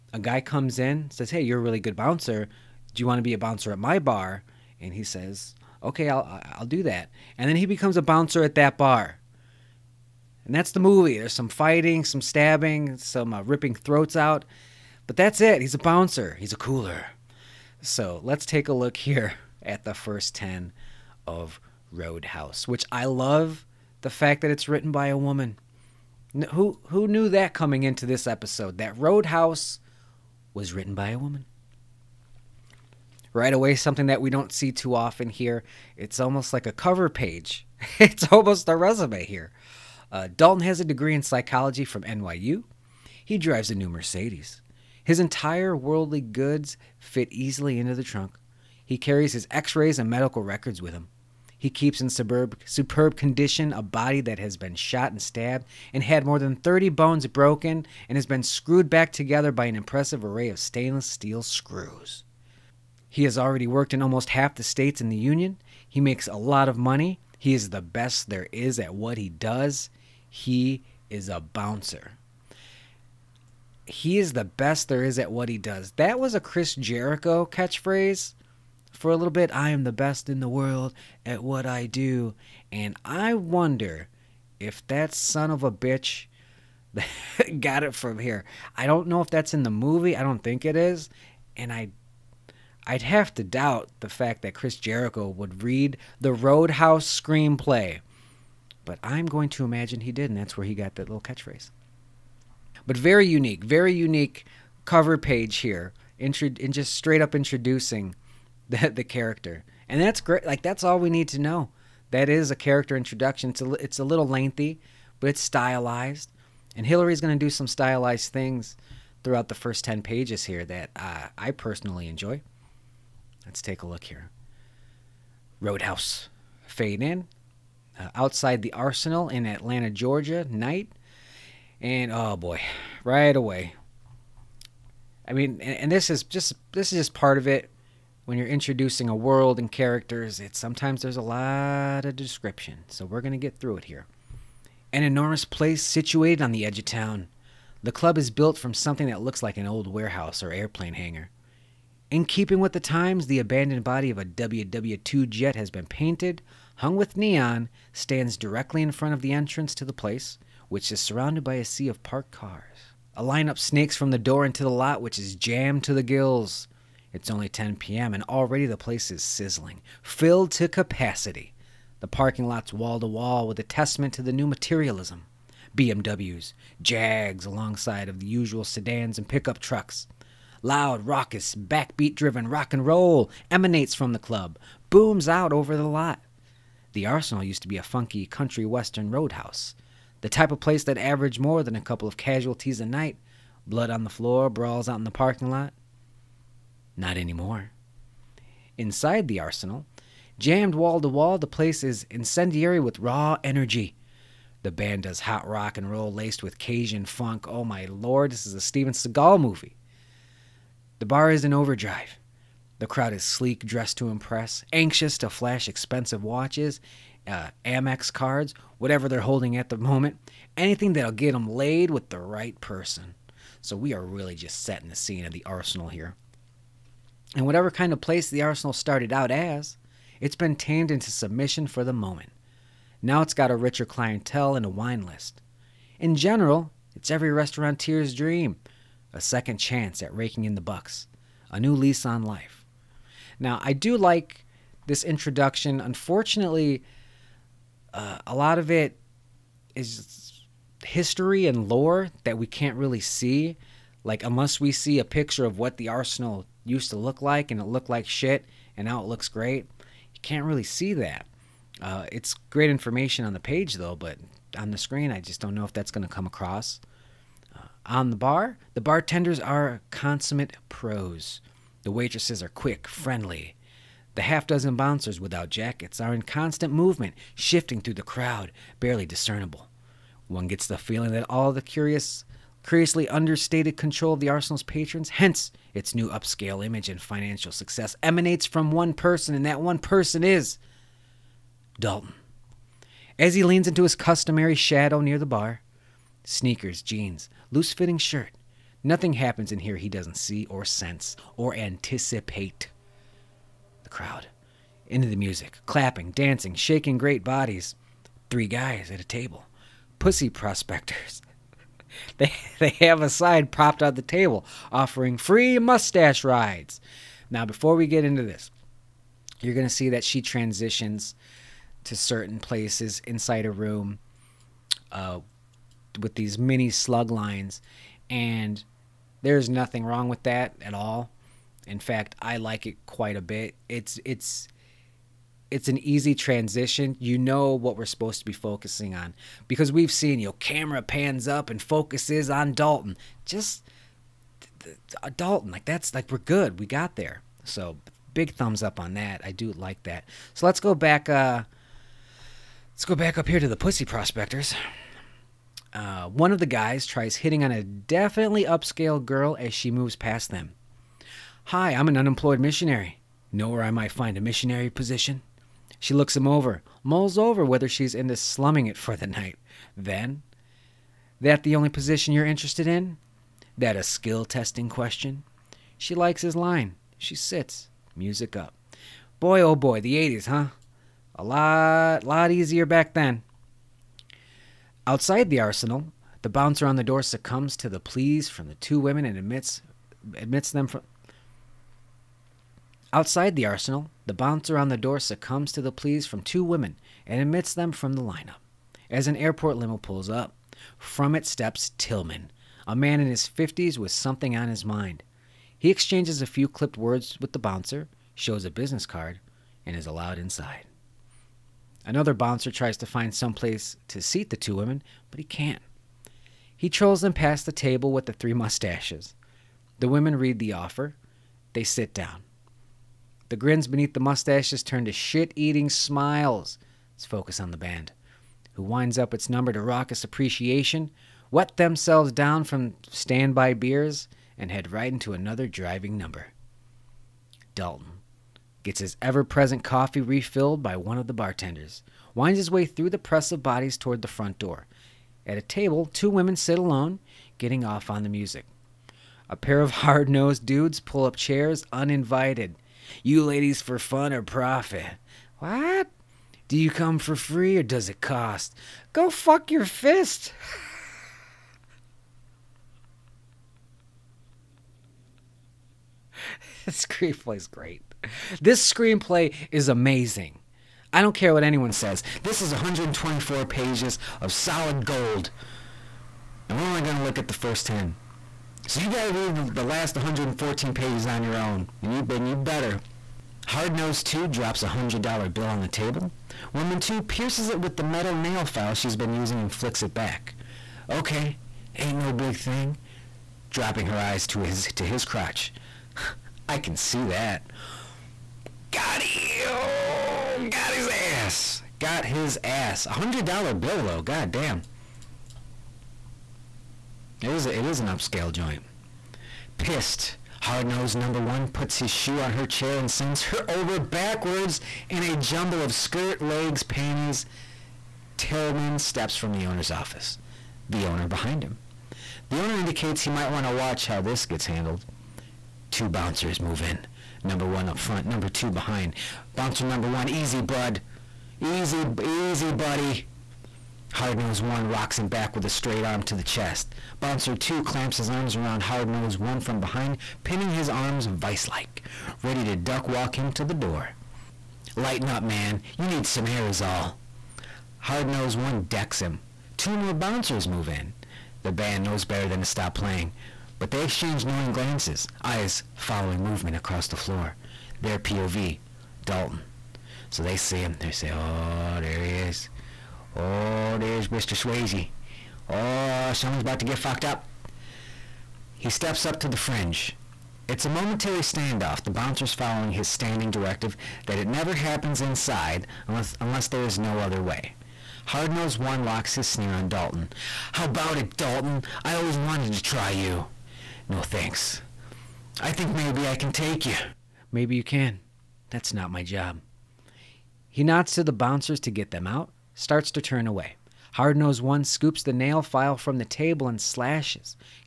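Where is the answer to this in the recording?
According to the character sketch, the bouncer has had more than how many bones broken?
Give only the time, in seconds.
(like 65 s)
56 s.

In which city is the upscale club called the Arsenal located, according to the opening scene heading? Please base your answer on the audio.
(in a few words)
Atlanta, Georgia.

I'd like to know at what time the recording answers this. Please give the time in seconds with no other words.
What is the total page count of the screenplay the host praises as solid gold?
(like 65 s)
472 s.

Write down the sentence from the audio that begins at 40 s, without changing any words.
Uh, Dalton has a degree in psychology from NYU.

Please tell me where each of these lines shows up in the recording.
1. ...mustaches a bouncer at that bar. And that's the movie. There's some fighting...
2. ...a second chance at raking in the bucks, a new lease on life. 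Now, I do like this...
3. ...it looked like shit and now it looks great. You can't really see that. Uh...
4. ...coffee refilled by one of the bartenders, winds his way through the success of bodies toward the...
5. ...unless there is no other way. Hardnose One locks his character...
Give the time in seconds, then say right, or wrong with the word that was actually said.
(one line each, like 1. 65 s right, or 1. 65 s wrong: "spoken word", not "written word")
1. 7 s wrong: "becomes", not "mustaches"
2. 239 s right
3. 257 s right
4. 439 s wrong: "press", not "success"
5. 576 s wrong: "sneer", not "character".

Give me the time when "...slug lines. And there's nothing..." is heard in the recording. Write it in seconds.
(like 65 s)
326 s.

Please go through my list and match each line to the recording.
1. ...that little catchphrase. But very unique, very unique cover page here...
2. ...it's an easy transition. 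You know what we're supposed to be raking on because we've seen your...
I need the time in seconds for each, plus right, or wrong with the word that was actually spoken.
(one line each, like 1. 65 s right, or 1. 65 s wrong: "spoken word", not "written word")
1. 100 s right
2. 335 s wrong: "focusing", not "raking".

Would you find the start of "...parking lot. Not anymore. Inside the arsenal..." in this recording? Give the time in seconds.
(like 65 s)
195 s.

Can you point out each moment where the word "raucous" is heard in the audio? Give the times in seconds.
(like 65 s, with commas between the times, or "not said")
181 s, 429 s.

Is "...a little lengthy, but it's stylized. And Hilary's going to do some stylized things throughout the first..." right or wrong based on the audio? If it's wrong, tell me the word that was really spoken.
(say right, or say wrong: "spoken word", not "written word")
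right.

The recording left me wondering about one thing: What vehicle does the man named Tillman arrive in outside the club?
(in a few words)
Airport limo.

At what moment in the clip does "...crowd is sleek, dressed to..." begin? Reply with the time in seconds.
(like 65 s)
212 s.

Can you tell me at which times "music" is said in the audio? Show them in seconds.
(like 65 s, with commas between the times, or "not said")
305 s, 377 s, 448 s.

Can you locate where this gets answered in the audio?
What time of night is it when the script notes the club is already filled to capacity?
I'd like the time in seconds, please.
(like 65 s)
167 s.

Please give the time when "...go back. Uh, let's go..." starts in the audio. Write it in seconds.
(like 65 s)
350 s.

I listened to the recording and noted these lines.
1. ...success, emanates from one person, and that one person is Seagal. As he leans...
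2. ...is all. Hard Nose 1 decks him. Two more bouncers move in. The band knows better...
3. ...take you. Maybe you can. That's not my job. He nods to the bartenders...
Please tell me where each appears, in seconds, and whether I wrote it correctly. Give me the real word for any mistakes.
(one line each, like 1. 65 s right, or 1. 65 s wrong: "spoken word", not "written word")
1. 287 s wrong: "Dalton", not "Seagal"
2. 546 s right
3. 586 s wrong: "bouncers", not "bartenders".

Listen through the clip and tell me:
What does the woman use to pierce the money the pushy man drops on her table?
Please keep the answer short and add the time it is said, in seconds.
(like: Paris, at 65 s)
Metal nail file, at 487 s.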